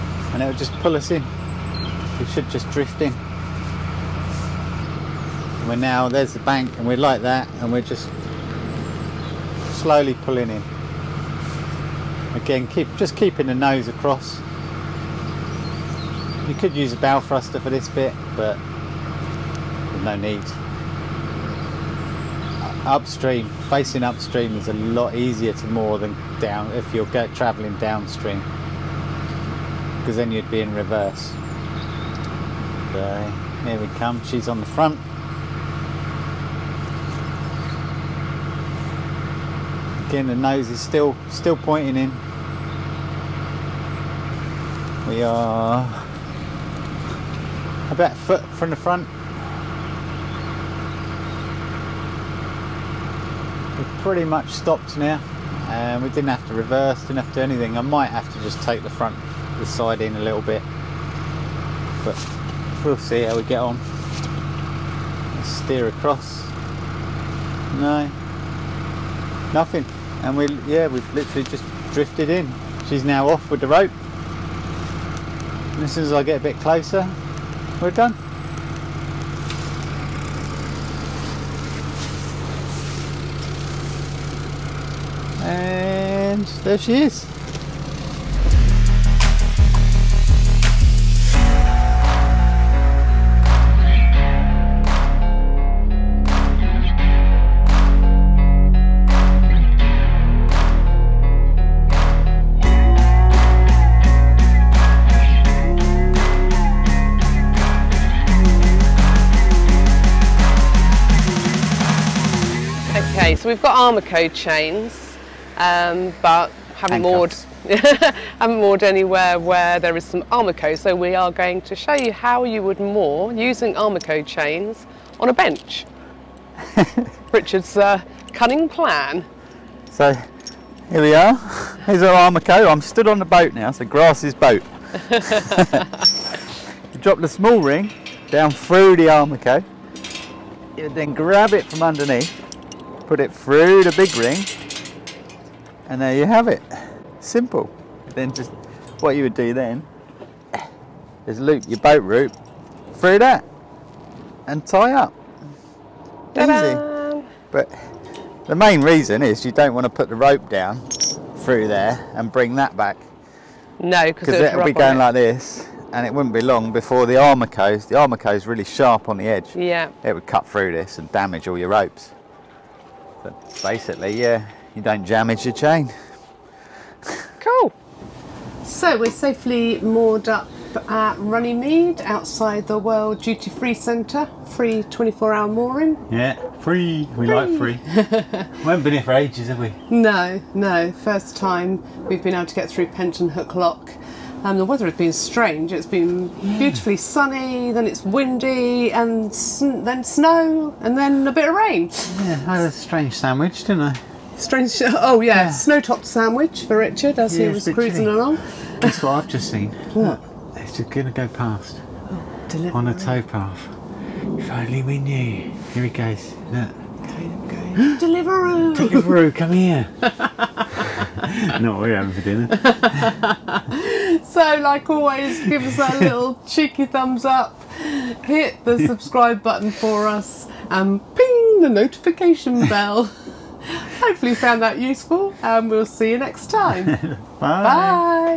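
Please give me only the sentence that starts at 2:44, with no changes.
like this and it wouldn't be long before the armor The armor goes really sharp on the edge.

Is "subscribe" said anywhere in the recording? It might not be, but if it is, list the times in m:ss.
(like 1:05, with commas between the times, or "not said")
3:48.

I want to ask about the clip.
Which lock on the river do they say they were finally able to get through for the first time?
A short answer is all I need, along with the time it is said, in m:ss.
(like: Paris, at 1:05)
Penton Hook Lock, at 3:12.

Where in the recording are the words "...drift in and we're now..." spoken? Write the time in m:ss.
0:02.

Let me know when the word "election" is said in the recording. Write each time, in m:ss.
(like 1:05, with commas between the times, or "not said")
not said.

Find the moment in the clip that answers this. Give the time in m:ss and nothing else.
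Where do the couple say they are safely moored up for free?
3:01.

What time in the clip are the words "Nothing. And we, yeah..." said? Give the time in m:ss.
1:09.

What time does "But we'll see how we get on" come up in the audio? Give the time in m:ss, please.
1:02.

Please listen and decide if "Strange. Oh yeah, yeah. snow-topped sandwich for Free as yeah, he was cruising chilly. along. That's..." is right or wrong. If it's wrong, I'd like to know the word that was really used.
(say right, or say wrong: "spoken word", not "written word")
wrong: "Richard", not "Free".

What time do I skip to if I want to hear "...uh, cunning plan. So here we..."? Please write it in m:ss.
2:07.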